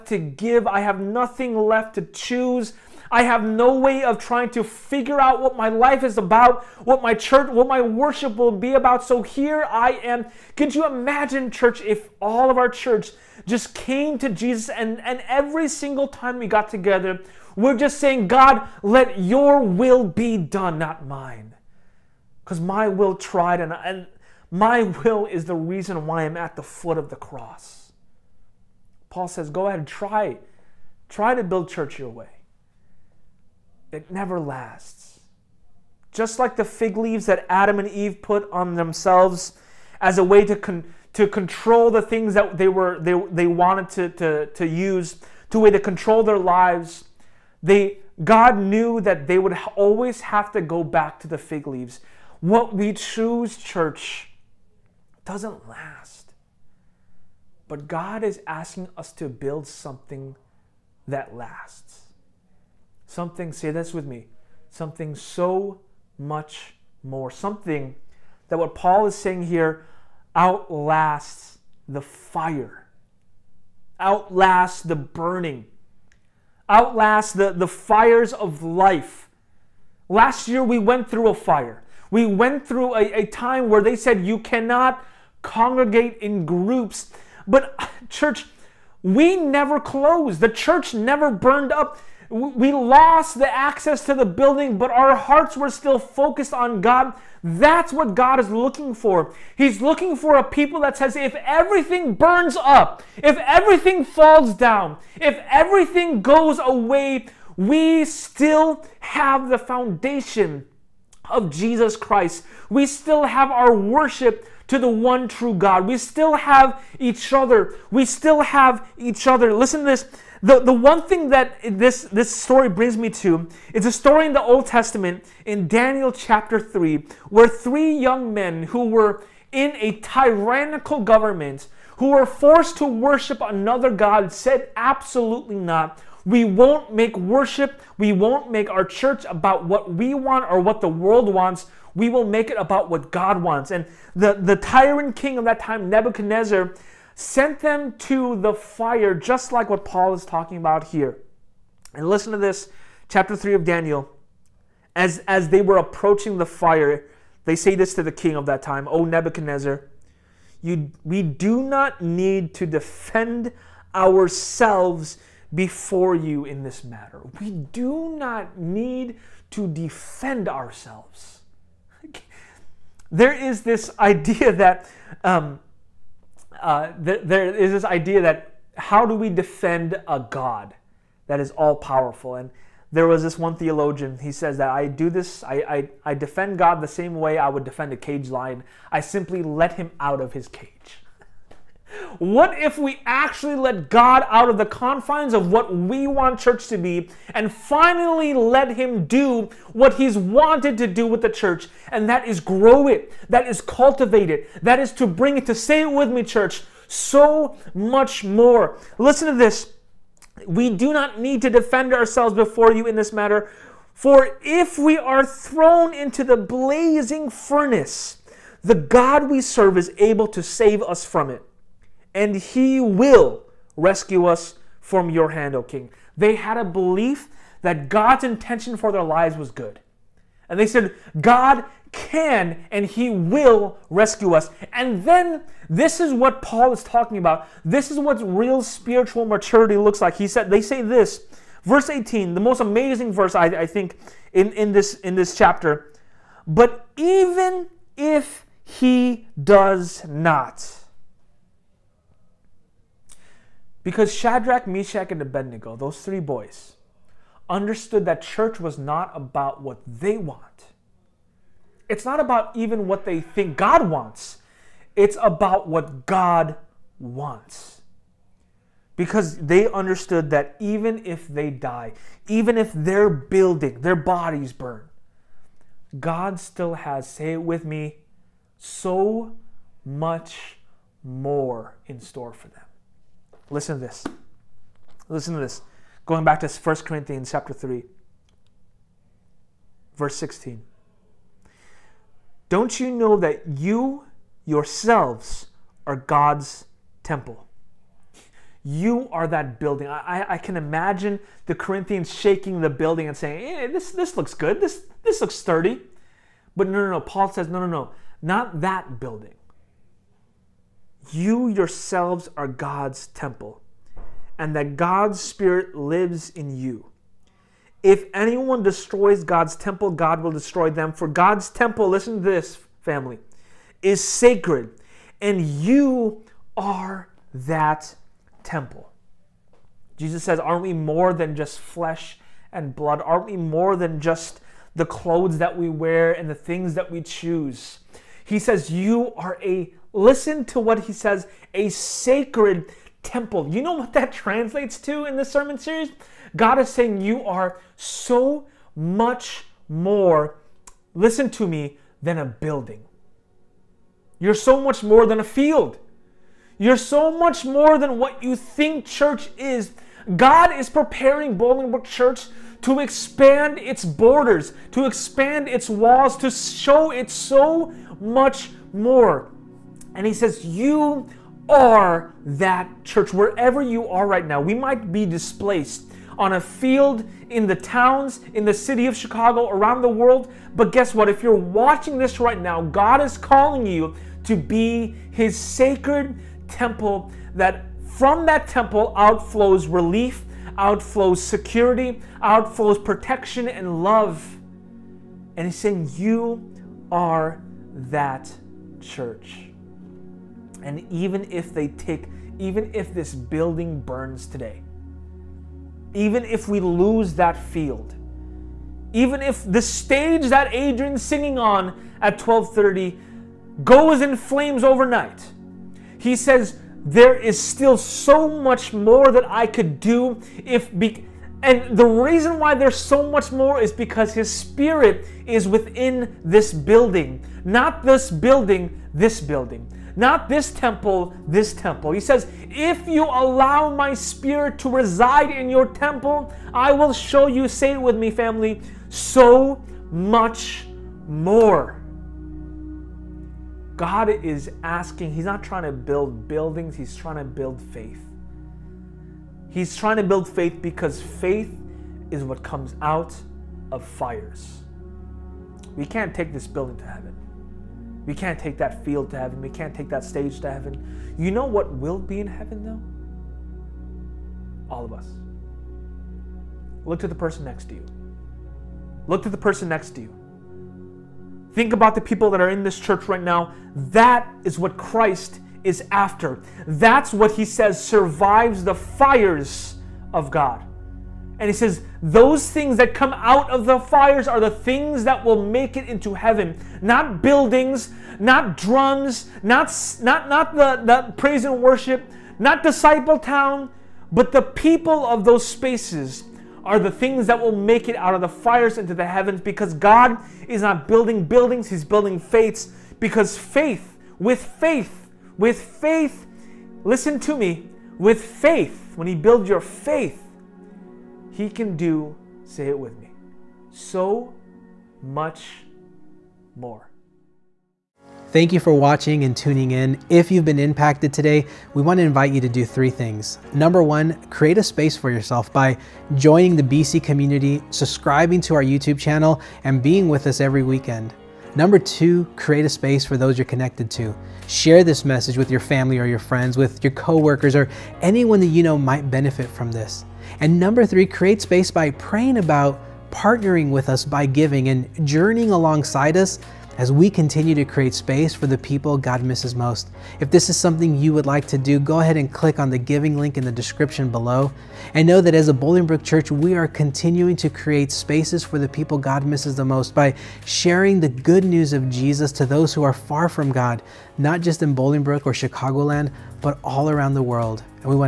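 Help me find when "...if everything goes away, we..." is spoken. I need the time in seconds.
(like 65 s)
105 s.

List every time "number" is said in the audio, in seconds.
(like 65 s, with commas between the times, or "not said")
523 s, 531 s, 540 s.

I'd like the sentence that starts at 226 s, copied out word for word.
They had a belief that God's intention for their lives was good.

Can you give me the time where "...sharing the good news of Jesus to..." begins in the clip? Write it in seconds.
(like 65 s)
560 s.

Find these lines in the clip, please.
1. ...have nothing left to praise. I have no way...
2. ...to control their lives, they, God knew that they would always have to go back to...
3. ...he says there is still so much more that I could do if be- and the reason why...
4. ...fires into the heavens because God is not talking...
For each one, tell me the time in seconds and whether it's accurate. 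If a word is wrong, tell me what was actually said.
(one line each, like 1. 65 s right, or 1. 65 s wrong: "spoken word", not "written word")
1. 0 s wrong: "choose", not "praise"
2. 45 s right
3. 415 s right
4. 498 s wrong: "building", not "talking".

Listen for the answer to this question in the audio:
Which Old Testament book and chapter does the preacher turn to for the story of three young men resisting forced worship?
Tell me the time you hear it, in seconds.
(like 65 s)
125 s.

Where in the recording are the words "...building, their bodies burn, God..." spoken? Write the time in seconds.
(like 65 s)
273 s.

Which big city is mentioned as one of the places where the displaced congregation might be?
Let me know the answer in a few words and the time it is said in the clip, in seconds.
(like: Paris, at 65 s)
Chicago, at 378 s.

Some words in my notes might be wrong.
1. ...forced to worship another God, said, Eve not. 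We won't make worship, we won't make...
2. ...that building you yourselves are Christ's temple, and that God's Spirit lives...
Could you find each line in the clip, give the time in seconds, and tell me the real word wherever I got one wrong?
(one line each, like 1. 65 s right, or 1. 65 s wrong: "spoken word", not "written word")
1. 132 s wrong: "Absolutely", not "Eve"
2. 308 s wrong: "God", not "Christ".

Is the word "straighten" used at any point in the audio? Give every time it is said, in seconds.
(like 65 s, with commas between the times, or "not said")
not said.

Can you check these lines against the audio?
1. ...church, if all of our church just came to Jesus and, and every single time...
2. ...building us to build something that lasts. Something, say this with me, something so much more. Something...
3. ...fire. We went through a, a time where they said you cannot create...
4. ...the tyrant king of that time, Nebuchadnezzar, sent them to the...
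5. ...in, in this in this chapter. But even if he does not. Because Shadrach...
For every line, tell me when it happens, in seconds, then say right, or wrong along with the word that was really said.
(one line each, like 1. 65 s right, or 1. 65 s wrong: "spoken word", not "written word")
1. 11 s right
2. 58 s wrong: "asking", not "building"
3. 81 s wrong: "congregate", not "create"
4. 144 s right
5. 244 s right.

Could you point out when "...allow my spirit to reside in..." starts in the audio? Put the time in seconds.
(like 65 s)
433 s.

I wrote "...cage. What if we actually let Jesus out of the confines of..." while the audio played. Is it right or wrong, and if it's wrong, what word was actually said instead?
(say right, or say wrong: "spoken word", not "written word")
wrong: "God", not "Jesus".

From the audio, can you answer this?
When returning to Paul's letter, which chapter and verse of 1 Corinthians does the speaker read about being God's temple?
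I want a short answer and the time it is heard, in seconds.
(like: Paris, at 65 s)
chapter 3, verse 16, at 286 s.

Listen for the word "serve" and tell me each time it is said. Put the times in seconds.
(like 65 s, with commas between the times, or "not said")
219 s.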